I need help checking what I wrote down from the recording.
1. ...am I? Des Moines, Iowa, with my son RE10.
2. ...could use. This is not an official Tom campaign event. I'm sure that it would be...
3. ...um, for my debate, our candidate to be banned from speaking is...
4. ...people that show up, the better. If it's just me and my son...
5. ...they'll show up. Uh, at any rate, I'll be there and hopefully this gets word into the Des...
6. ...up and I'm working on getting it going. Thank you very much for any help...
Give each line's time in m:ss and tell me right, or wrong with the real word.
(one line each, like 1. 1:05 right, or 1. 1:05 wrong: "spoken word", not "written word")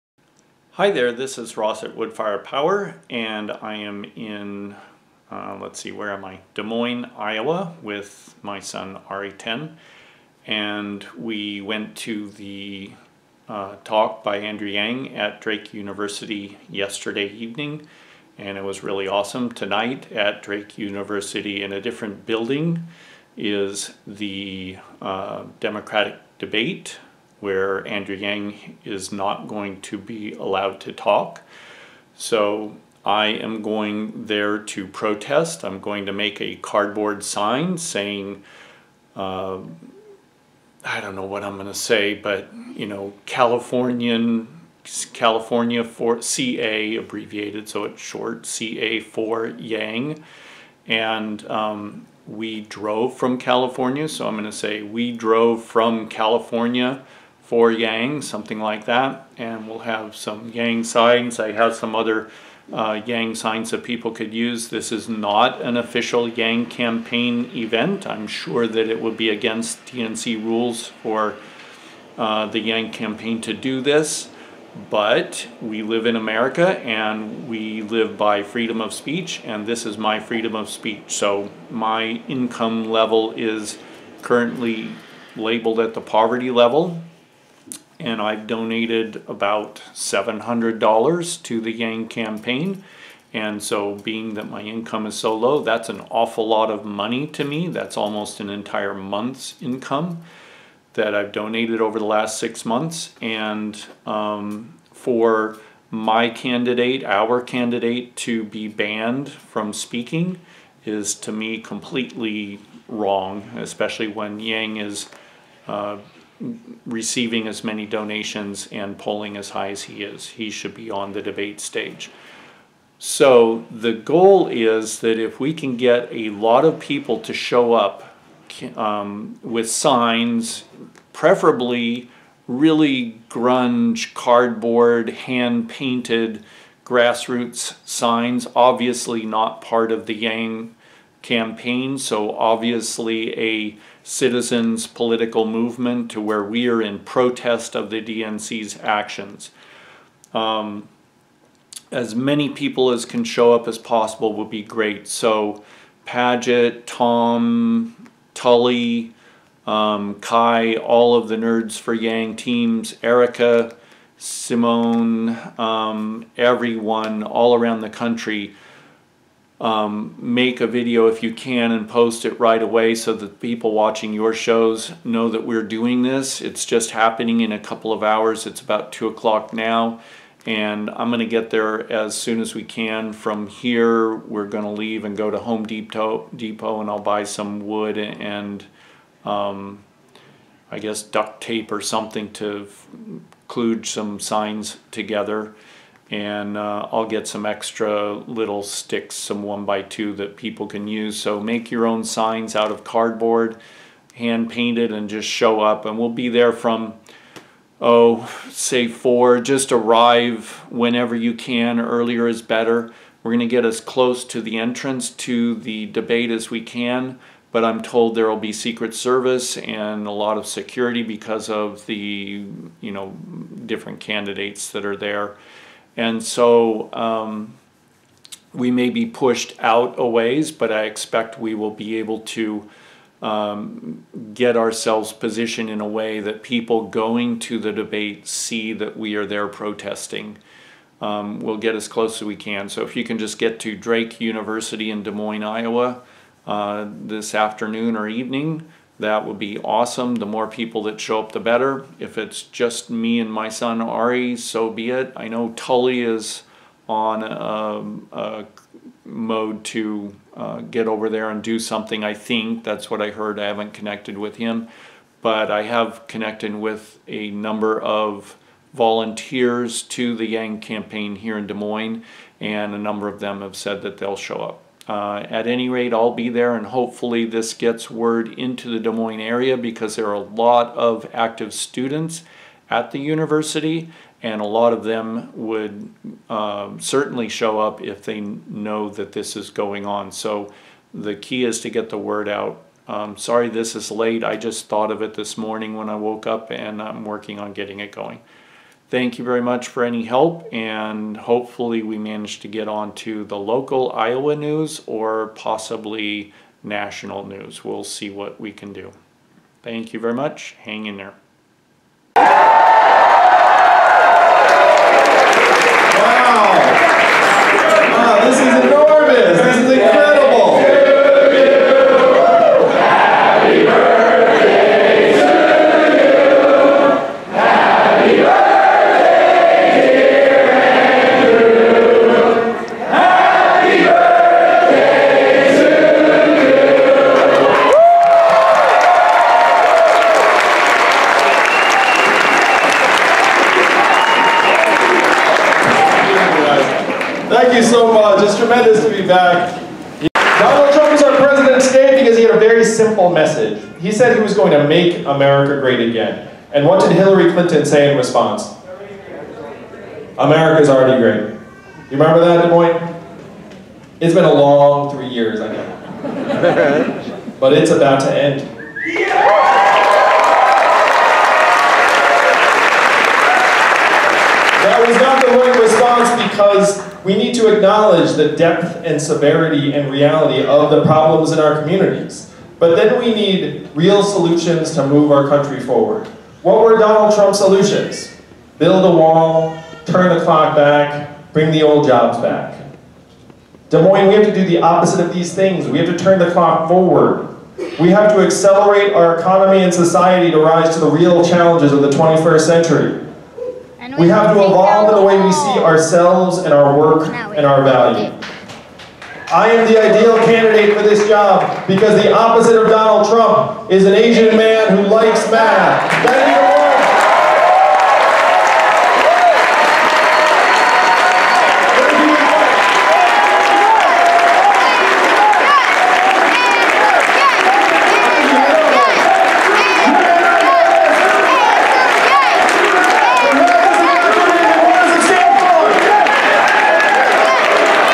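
1. 0:06 right
2. 1:04 wrong: "Yang", not "Tom"
3. 1:44 wrong: "candidate", not "debate"
4. 4:10 right
5. 4:33 right
6. 4:56 right.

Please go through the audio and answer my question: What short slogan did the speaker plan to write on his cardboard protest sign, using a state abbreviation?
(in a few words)
CA for Yang.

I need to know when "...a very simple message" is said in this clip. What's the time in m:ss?
5:52.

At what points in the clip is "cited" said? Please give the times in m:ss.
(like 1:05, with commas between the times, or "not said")
not said.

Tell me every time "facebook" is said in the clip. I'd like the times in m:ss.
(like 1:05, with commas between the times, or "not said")
not said.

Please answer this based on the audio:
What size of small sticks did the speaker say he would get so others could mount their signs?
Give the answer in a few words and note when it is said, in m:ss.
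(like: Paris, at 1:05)
1 by 2, at 3:19.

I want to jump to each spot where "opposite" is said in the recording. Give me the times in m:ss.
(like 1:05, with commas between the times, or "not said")
6:34, 6:52.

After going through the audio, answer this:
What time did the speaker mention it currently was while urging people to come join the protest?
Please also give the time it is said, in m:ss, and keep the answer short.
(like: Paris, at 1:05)
2 o'clock, at 2:58.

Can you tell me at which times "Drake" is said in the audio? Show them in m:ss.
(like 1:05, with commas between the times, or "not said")
0:15, 0:20, 4:03.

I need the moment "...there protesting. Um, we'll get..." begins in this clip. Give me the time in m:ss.
3:59.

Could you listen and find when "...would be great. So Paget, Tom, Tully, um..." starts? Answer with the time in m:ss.
2:34.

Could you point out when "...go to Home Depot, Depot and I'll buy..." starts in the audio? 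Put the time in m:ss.
3:05.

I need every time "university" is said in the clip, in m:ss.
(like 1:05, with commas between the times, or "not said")
0:15, 0:20, 4:04, 4:42.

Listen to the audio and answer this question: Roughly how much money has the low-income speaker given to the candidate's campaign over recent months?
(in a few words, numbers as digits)
$700.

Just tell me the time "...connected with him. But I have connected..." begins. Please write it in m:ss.
4:23.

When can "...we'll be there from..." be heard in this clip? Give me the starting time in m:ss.
3:25.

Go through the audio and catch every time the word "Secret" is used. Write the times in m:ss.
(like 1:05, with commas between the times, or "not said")
3:38.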